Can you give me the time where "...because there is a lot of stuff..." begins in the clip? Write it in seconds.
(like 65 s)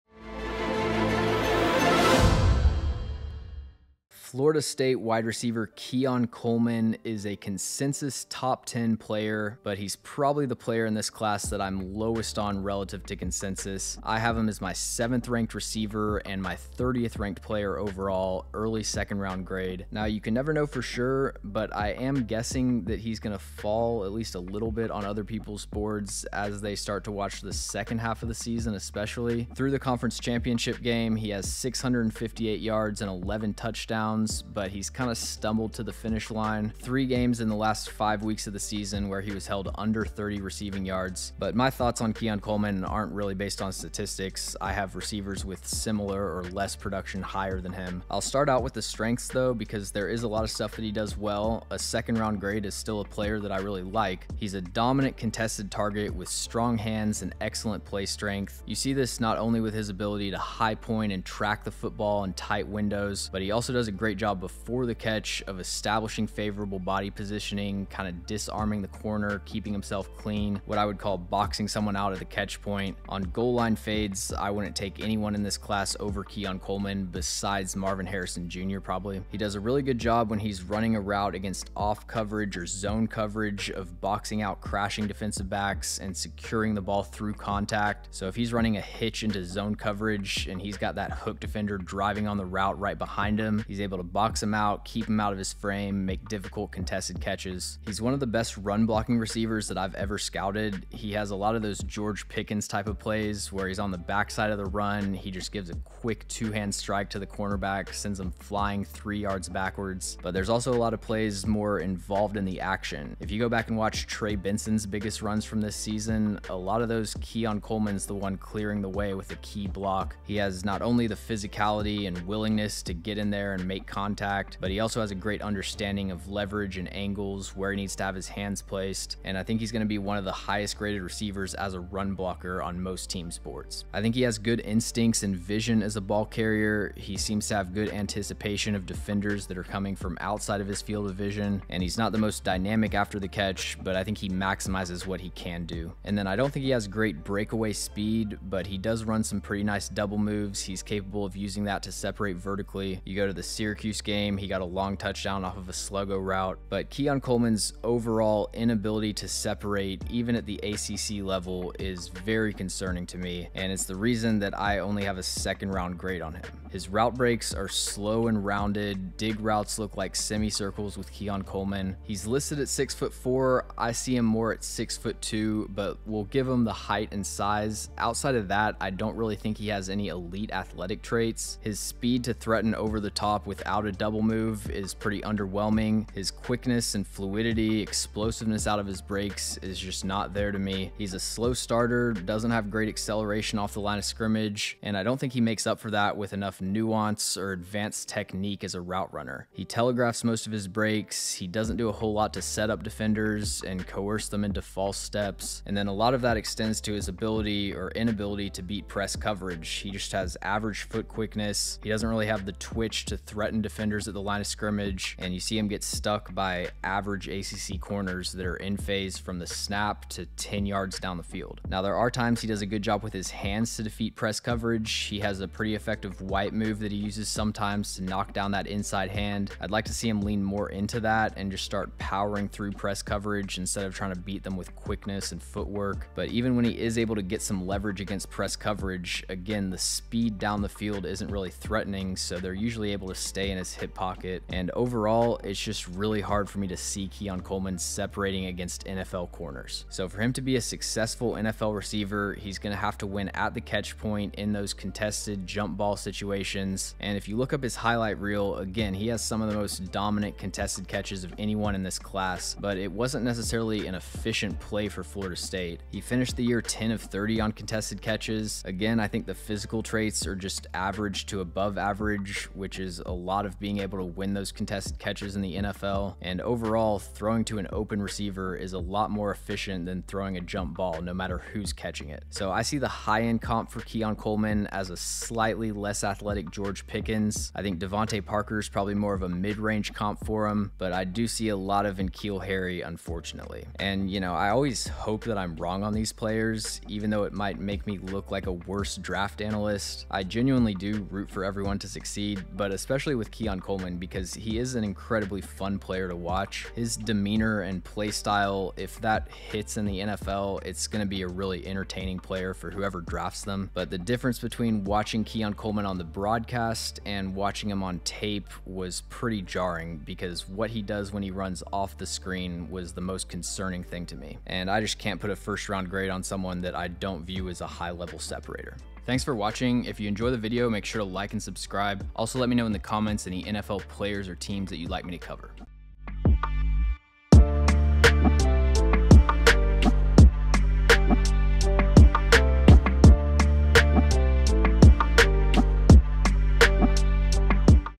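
49 s.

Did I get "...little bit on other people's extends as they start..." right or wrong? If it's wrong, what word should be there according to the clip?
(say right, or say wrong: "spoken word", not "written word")
wrong: "boards", not "extends".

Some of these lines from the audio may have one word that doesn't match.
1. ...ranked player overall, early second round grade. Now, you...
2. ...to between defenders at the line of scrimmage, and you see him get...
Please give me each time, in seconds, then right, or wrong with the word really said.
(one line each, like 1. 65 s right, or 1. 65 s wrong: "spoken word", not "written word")
1. 17 s right
2. 213 s wrong: "threaten", not "between".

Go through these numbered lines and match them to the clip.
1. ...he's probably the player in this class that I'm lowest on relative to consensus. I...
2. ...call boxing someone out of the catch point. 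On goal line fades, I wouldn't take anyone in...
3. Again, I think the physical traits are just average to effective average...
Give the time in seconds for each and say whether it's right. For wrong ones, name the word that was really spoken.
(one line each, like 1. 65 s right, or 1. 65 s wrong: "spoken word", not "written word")
1. 9 s right
2. 70 s right
3. 268 s wrong: "above", not "effective".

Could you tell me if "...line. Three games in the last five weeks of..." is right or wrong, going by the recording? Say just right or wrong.
right.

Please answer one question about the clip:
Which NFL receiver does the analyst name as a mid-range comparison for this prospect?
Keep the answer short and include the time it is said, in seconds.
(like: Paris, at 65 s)
DeVante Parker, at 287 s.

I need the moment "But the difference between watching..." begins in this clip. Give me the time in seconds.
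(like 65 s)
313 s.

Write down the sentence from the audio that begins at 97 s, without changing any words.
He's one of the best run blocking receivers that I've ever scouted.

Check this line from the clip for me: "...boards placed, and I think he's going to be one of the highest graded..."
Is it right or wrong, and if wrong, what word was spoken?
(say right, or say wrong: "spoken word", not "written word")
wrong: "hands", not "boards".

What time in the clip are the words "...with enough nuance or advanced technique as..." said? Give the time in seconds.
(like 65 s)
196 s.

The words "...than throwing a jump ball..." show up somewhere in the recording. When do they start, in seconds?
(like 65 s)
279 s.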